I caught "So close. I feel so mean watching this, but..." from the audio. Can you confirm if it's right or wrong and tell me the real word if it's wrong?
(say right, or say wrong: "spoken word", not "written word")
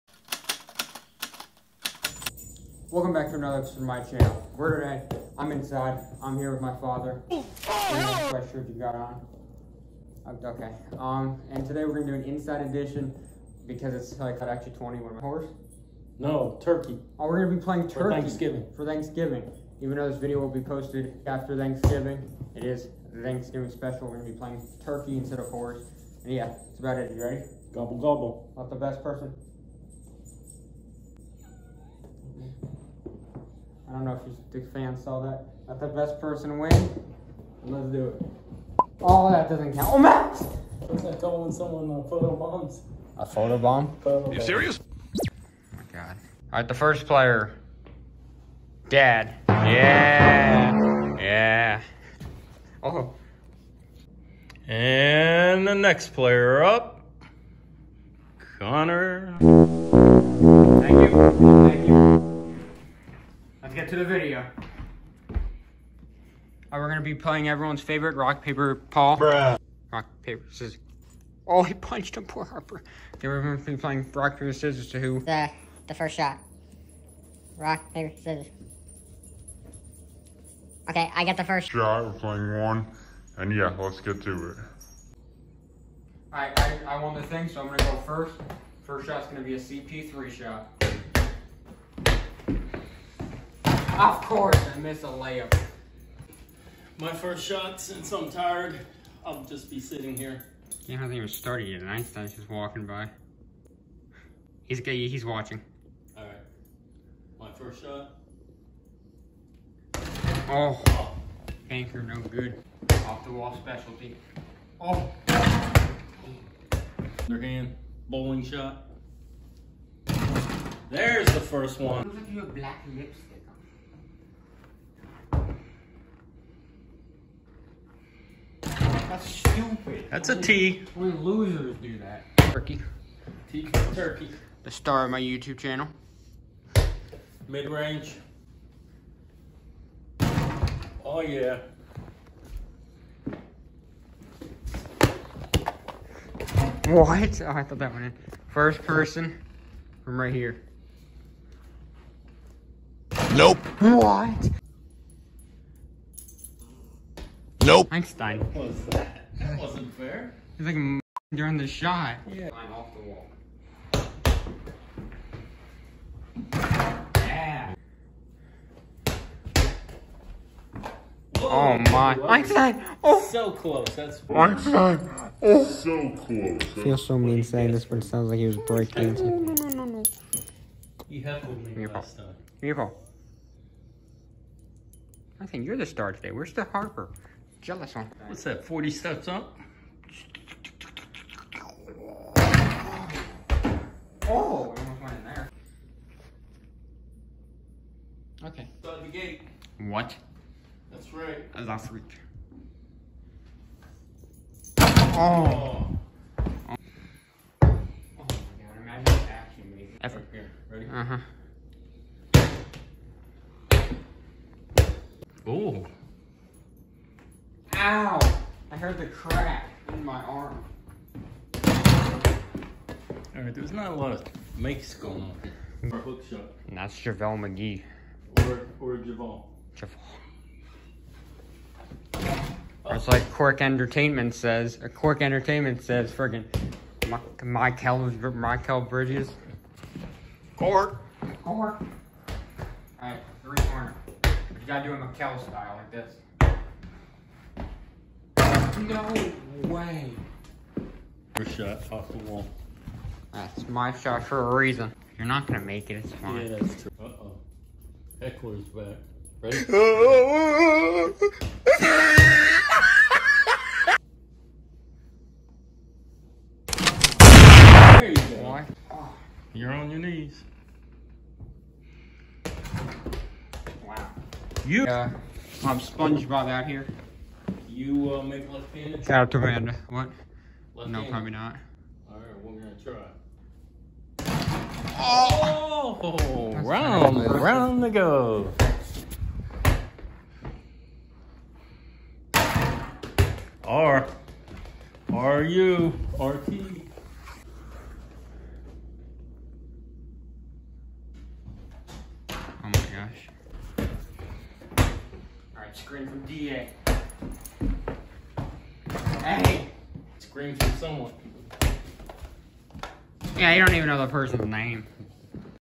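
wrong: "saying", not "watching".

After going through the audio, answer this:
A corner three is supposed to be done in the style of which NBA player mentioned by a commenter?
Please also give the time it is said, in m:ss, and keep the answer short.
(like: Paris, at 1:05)
Mikal Bridges, at 3:58.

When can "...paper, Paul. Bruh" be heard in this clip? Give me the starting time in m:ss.
1:08.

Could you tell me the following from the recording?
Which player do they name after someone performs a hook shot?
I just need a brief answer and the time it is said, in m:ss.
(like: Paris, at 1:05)
JaVale McGee, at 3:46.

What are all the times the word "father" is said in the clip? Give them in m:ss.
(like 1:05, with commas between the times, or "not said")
0:06.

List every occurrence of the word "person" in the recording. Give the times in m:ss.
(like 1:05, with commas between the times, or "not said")
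0:29, 0:36, 2:28, 5:14.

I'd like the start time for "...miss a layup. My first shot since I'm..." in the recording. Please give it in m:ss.
1:34.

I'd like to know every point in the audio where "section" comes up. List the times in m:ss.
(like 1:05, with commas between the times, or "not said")
not said.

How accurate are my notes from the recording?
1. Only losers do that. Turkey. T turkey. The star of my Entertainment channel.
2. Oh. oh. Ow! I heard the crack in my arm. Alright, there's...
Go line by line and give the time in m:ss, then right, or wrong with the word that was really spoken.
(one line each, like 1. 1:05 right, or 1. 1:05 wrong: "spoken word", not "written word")
1. 2:10 wrong: "YouTube", not "Entertainment"
2. 3:35 right.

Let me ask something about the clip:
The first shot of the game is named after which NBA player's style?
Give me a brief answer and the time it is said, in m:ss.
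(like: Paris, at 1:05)
CP3, at 1:29.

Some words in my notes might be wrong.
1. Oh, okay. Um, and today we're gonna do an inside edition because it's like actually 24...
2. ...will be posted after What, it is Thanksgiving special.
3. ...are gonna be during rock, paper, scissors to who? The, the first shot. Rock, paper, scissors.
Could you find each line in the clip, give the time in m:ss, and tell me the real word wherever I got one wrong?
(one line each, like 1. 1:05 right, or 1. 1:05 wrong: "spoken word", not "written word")
1. 0:10 wrong: "21", not "24"
2. 0:20 wrong: "Thanksgiving", not "What"
3. 1:13 wrong: "playing", not "during".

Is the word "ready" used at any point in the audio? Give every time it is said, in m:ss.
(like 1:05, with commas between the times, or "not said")
0:27, 3:30, 4:19.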